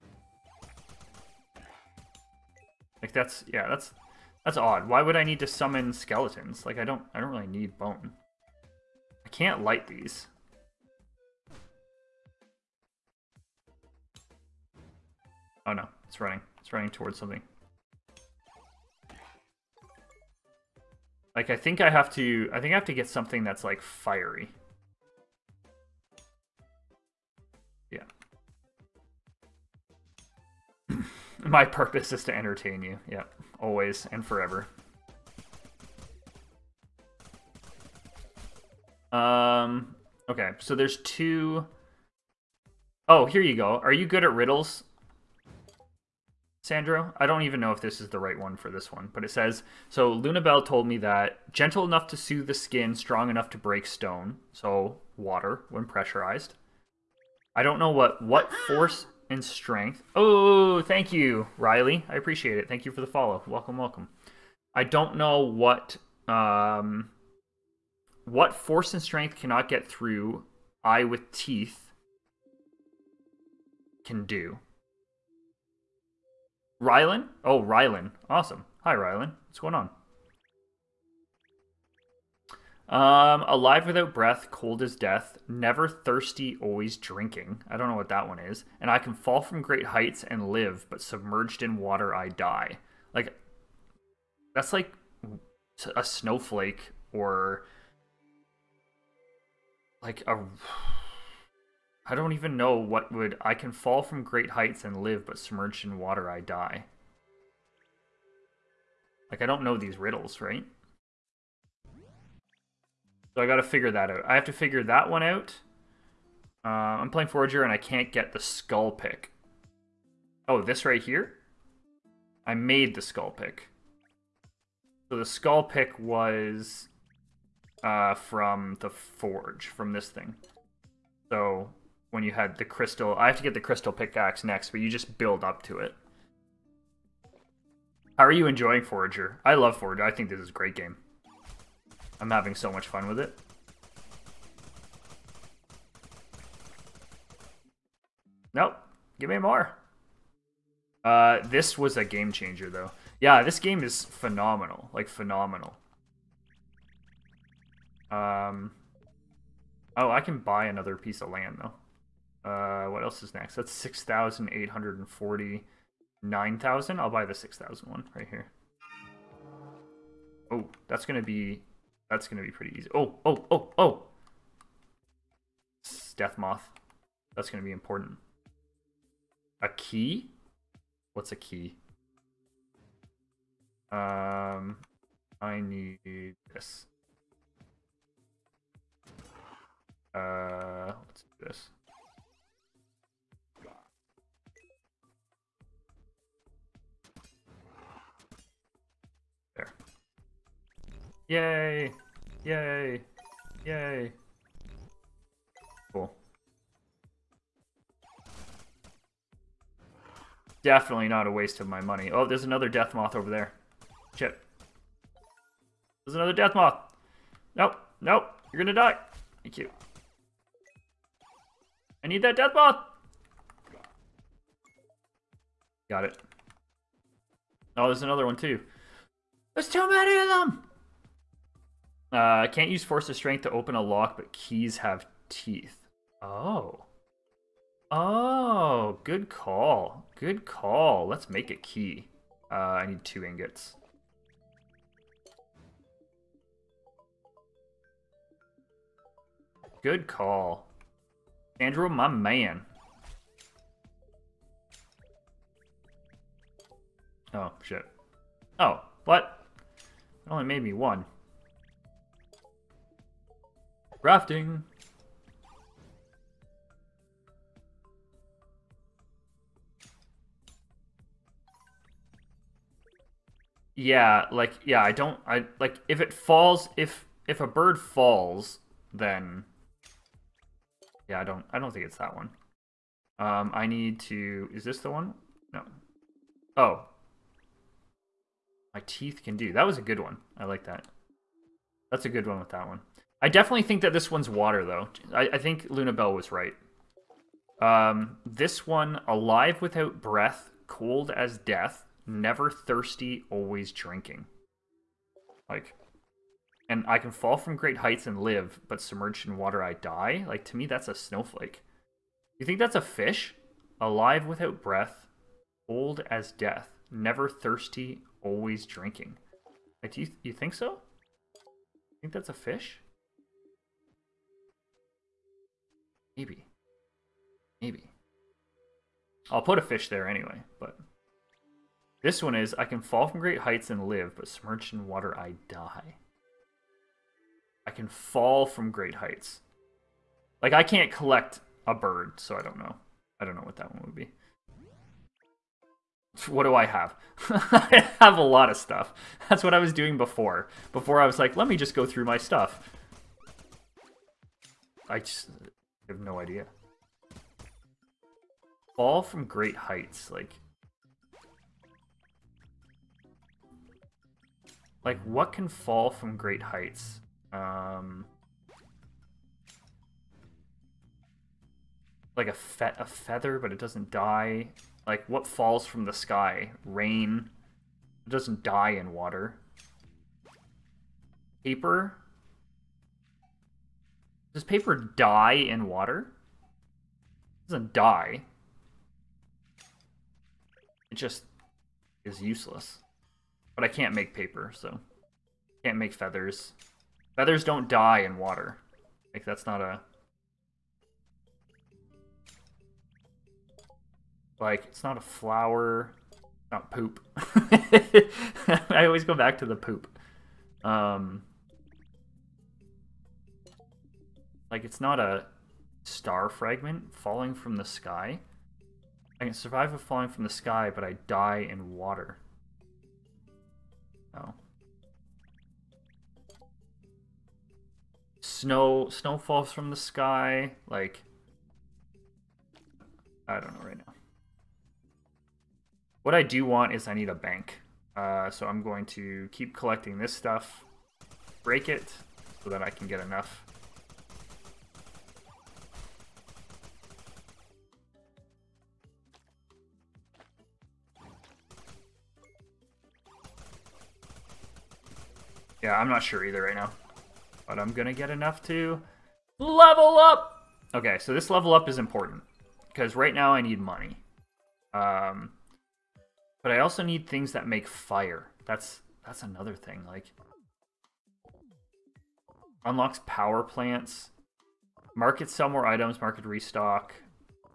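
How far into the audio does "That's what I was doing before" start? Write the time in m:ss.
5:49.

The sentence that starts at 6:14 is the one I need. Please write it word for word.
Like, what falls from the sky?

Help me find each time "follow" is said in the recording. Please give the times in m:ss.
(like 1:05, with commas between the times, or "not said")
1:03.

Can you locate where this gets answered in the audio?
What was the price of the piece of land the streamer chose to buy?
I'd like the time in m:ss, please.
2:43.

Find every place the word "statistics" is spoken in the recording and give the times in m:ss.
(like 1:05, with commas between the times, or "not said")
not said.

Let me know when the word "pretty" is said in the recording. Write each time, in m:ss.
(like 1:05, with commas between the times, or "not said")
2:52.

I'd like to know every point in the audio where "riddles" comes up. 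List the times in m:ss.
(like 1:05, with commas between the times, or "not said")
0:44, 1:49.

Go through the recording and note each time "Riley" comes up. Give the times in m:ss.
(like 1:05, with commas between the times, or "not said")
1:01.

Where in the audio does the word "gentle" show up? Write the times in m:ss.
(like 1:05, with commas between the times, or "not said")
0:51.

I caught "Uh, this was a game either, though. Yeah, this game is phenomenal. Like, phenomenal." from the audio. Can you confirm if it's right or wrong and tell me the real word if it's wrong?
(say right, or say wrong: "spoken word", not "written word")
wrong: "changer", not "either".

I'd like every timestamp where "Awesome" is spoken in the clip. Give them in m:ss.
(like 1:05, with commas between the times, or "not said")
1:18.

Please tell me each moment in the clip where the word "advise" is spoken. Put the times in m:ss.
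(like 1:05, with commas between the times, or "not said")
not said.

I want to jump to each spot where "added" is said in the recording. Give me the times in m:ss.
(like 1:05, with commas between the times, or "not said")
not said.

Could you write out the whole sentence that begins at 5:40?
Like, I can't collect a bird, so I don't know.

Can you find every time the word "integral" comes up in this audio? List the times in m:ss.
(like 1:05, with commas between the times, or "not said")
not said.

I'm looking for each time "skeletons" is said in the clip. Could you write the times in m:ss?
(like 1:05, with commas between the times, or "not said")
0:05.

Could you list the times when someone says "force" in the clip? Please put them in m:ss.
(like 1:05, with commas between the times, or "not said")
0:58, 1:08, 3:52.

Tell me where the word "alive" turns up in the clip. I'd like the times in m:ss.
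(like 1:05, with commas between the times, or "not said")
1:23, 4:59, 5:13.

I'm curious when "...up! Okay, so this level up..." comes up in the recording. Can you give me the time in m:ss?
7:39.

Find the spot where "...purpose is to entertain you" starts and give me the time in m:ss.
0:31.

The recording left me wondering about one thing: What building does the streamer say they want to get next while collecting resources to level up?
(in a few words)
bank.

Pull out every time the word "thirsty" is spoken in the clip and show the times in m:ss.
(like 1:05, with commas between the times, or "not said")
1:25, 5:02, 5:17.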